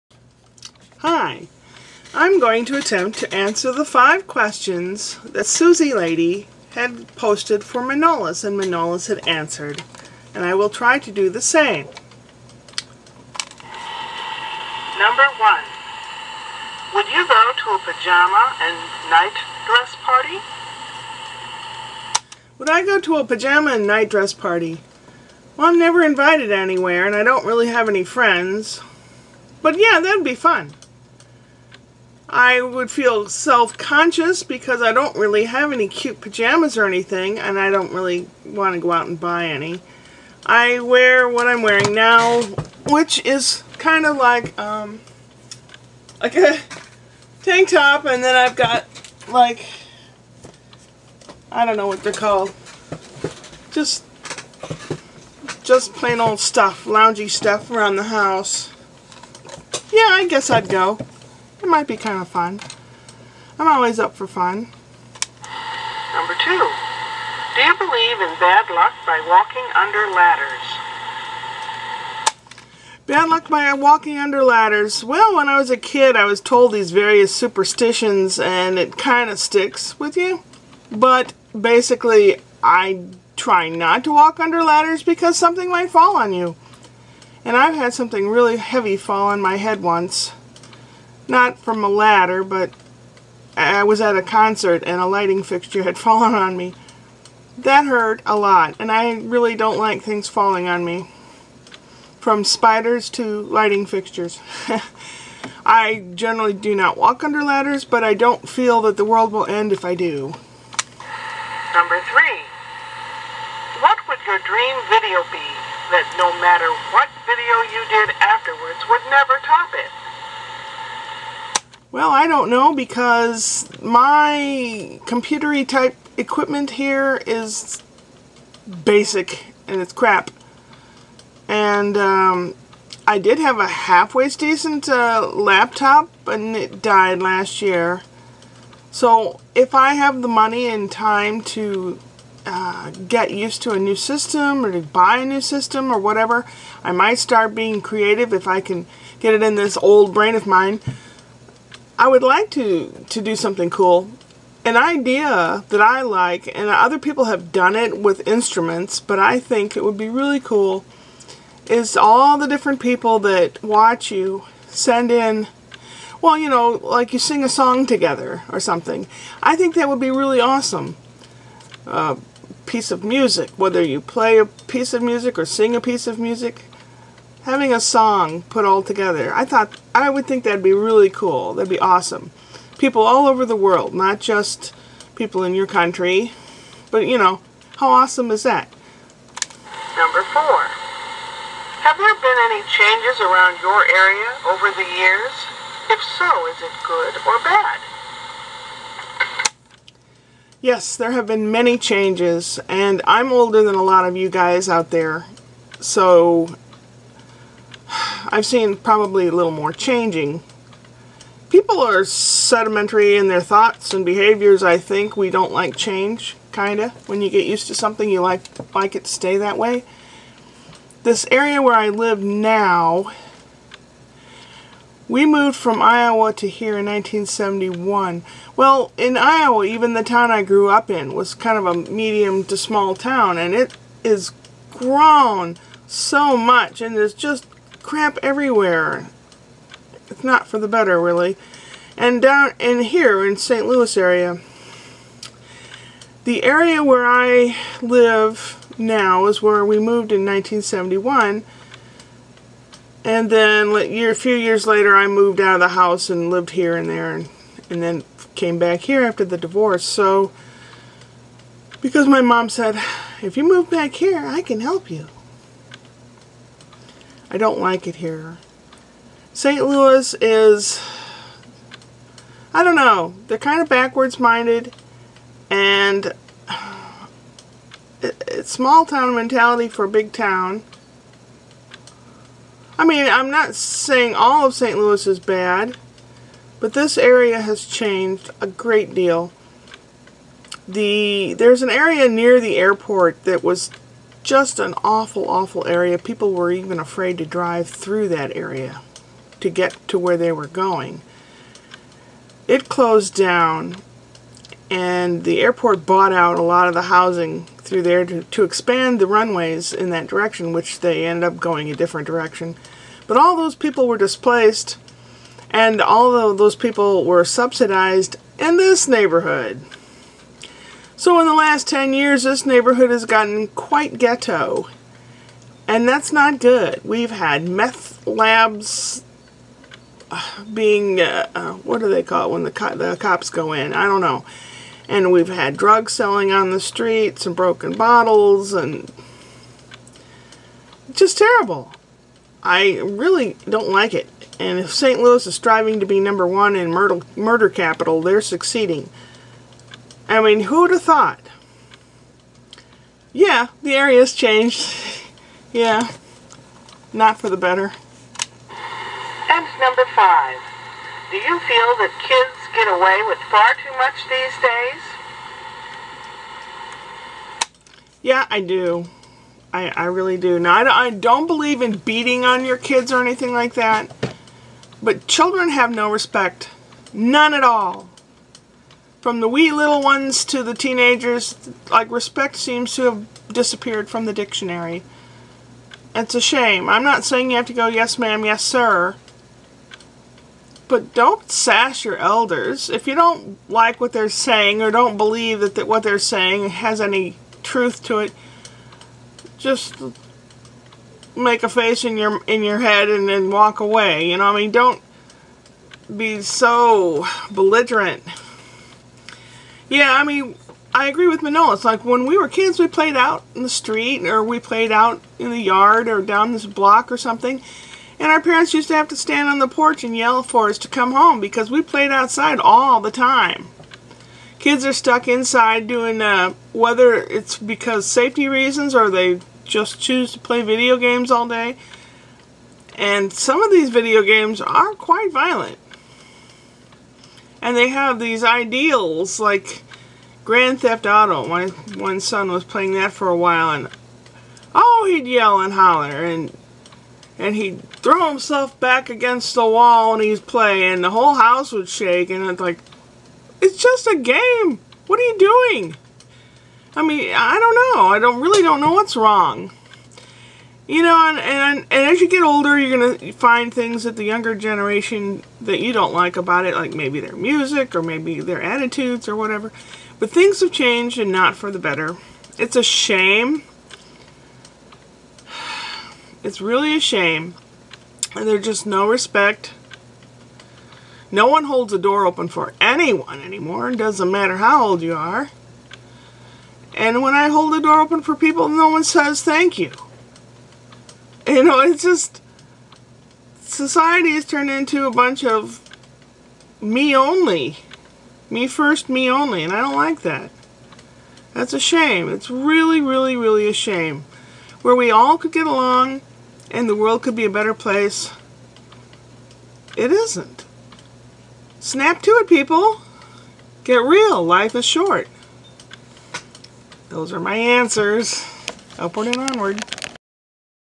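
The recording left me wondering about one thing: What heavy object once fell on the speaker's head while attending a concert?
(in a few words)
A lighting fixture.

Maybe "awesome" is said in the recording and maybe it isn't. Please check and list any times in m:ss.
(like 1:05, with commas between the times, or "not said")
2:50, 3:01, 3:07.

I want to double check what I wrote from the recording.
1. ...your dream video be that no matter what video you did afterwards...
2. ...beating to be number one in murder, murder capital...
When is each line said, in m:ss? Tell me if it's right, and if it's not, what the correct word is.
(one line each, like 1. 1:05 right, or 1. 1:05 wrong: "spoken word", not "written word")
1. 1:54 right
2. 5:45 wrong: "striving", not "beating".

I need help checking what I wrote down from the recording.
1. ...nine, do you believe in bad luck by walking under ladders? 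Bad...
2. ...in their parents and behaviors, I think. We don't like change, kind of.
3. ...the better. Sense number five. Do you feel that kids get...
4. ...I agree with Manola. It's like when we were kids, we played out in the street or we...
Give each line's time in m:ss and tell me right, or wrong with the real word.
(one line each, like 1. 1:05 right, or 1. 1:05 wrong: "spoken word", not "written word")
1. 1:06 wrong: "two", not "nine"
2. 3:33 wrong: "thoughts", not "parents"
3. 5:57 right
4. 6:50 right.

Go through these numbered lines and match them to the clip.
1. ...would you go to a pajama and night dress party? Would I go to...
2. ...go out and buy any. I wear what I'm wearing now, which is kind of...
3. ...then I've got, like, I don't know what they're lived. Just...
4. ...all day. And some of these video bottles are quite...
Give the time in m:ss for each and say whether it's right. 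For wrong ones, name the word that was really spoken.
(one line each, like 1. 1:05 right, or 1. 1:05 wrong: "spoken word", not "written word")
1. 0:16 right
2. 0:38 right
3. 0:48 wrong: "called", not "lived"
4. 7:11 wrong: "games", not "bottles".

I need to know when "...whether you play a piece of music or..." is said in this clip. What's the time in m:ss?
2:53.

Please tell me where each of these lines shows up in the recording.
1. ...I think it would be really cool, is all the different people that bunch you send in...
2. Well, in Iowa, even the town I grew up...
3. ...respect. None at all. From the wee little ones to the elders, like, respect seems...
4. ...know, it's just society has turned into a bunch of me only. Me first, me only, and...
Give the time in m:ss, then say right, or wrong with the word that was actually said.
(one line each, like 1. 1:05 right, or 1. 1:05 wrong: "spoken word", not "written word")
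1. 2:39 wrong: "watch", not "bunch"
2. 3:48 right
3. 6:15 wrong: "teenagers", not "elders"
4. 8:11 right.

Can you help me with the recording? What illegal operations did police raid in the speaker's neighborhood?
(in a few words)
Meth labs.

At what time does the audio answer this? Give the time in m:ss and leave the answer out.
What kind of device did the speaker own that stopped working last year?
2:15.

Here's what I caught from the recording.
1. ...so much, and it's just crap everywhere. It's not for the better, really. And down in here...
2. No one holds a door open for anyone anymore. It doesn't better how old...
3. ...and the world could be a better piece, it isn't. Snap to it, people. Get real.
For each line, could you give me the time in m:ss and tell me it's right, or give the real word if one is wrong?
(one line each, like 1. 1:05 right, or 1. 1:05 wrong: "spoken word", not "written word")
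1. 3:55 right
2. 8:01 wrong: "matter", not "better"
3. 8:26 wrong: "place", not "piece".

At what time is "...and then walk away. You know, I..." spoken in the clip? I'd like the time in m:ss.
6:42.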